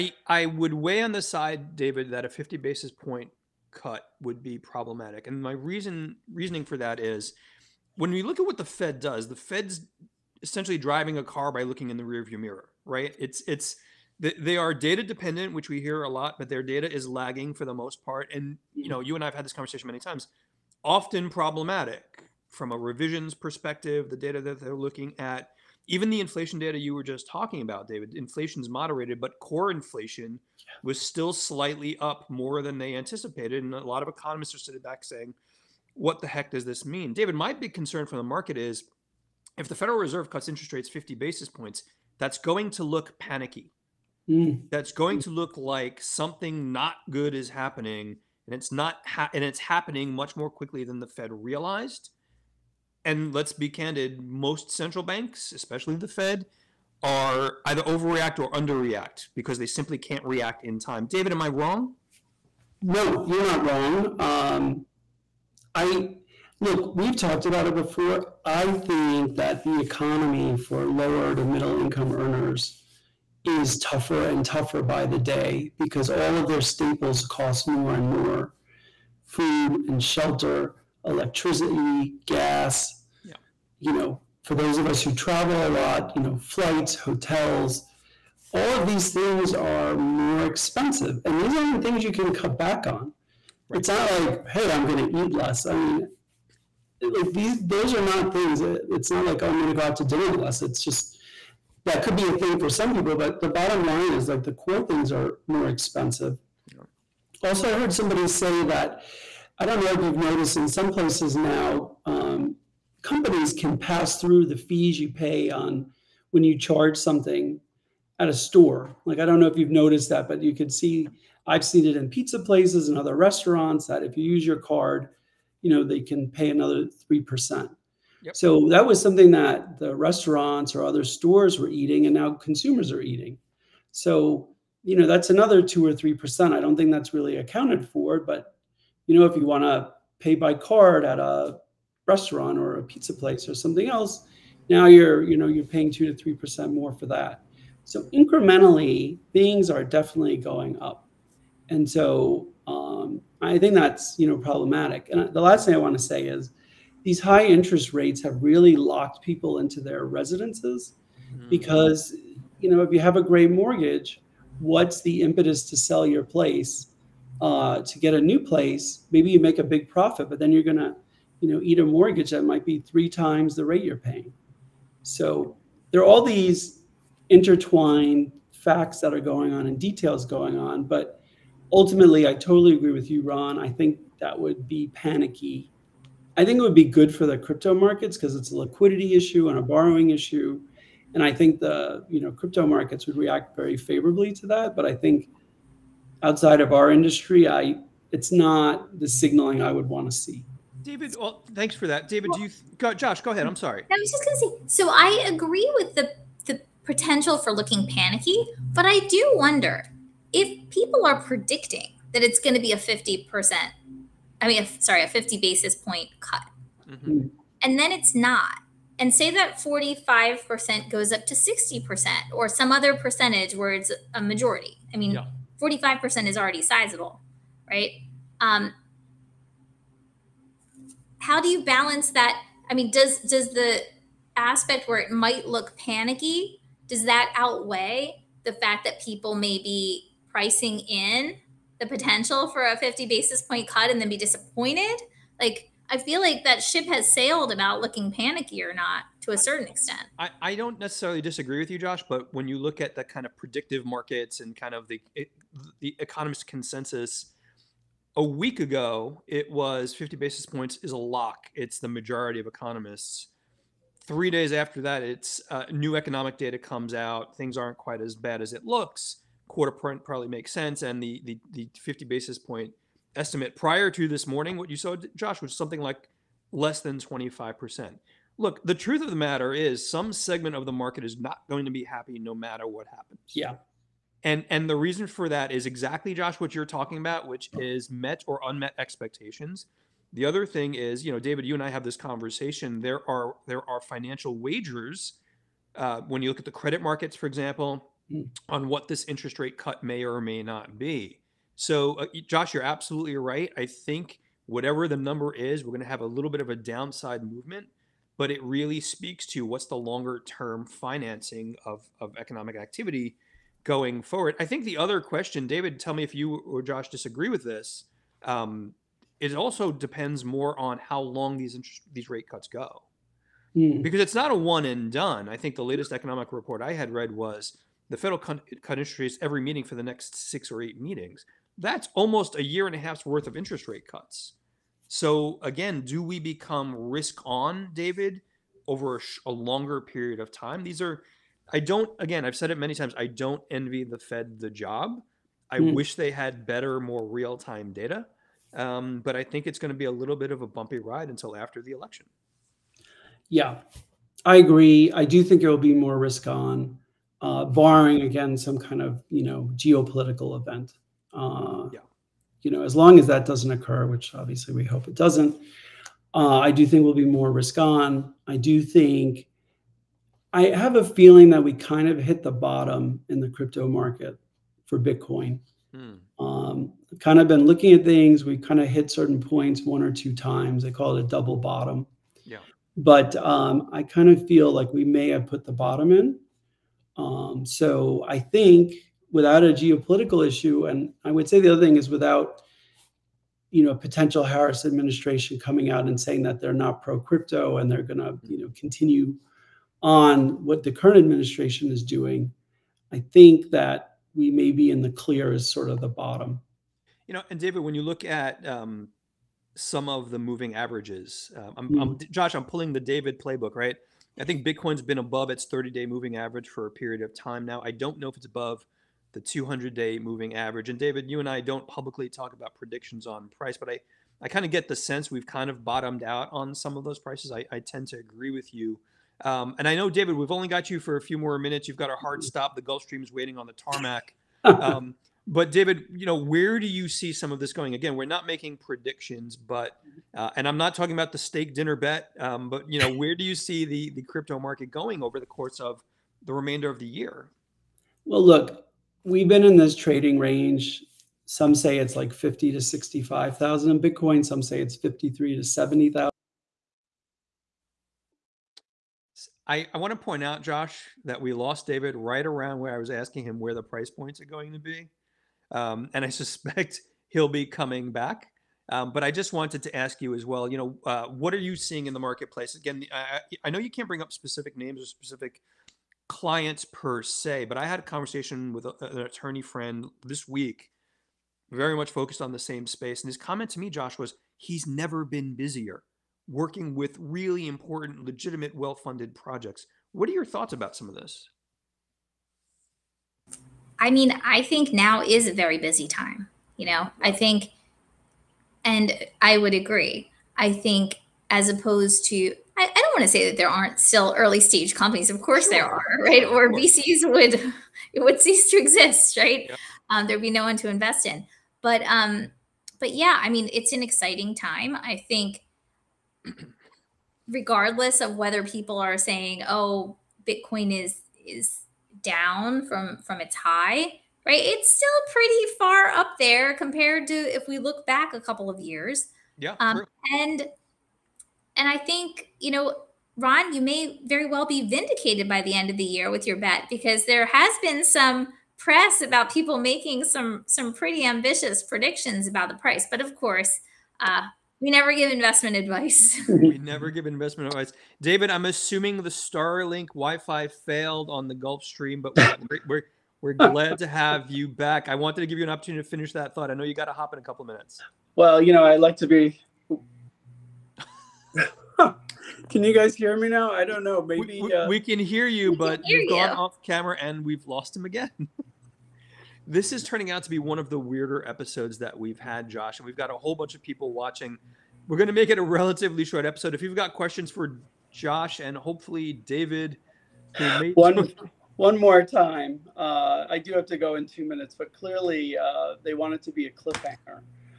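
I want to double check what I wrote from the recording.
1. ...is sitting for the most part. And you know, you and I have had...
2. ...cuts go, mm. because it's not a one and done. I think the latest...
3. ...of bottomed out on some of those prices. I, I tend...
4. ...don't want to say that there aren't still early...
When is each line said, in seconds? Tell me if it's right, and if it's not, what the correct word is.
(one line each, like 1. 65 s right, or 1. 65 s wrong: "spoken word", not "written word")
1. 16 s wrong: "lagging", not "sitting"
2. 322 s right
3. 425 s right
4. 502 s right.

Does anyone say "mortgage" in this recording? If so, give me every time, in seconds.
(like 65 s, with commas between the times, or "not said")
163 s, 171 s.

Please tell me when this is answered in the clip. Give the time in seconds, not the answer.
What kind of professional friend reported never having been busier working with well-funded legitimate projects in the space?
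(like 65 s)
478 s.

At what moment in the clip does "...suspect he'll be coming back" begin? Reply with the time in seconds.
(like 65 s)
466 s.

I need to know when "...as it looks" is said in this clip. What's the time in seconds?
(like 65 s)
268 s.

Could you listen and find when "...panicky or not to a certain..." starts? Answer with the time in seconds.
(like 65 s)
248 s.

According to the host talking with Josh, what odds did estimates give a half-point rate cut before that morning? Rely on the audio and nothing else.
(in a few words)
less than 25%.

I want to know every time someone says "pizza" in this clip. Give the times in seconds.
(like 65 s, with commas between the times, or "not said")
122 s, 142 s.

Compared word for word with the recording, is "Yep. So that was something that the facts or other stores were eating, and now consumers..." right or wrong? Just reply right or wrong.
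wrong.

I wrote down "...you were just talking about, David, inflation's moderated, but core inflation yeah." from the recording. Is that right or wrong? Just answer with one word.
right.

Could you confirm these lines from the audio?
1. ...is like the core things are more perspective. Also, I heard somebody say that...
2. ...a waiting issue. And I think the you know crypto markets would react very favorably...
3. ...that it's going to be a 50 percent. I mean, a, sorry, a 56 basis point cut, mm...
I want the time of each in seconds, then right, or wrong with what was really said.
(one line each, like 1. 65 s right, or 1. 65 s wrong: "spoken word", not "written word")
1. 104 s wrong: "expensive", not "perspective"
2. 189 s wrong: "borrowing", not "waiting"
3. 212 s wrong: "50", not "56".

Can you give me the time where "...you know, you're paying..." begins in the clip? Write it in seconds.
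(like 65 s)
145 s.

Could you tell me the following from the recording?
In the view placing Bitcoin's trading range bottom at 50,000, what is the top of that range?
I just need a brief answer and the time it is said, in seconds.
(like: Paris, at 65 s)
65,000, at 452 s.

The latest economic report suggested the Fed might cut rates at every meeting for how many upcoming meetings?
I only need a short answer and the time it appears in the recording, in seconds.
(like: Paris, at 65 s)
6 or 8, at 330 s.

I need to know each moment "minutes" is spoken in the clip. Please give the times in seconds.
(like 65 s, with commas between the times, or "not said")
431 s, 557 s, 584 s.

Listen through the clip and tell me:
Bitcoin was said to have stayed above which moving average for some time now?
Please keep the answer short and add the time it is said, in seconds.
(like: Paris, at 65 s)
30 day moving average, at 415 s.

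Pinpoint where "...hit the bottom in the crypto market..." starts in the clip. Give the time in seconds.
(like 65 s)
371 s.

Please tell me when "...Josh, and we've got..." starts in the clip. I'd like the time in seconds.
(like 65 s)
572 s.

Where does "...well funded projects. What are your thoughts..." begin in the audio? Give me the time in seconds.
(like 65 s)
488 s.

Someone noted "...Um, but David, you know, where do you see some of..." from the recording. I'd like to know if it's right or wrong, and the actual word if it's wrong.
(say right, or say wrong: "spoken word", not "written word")
right.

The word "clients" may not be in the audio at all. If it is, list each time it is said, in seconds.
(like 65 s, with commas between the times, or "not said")
476 s.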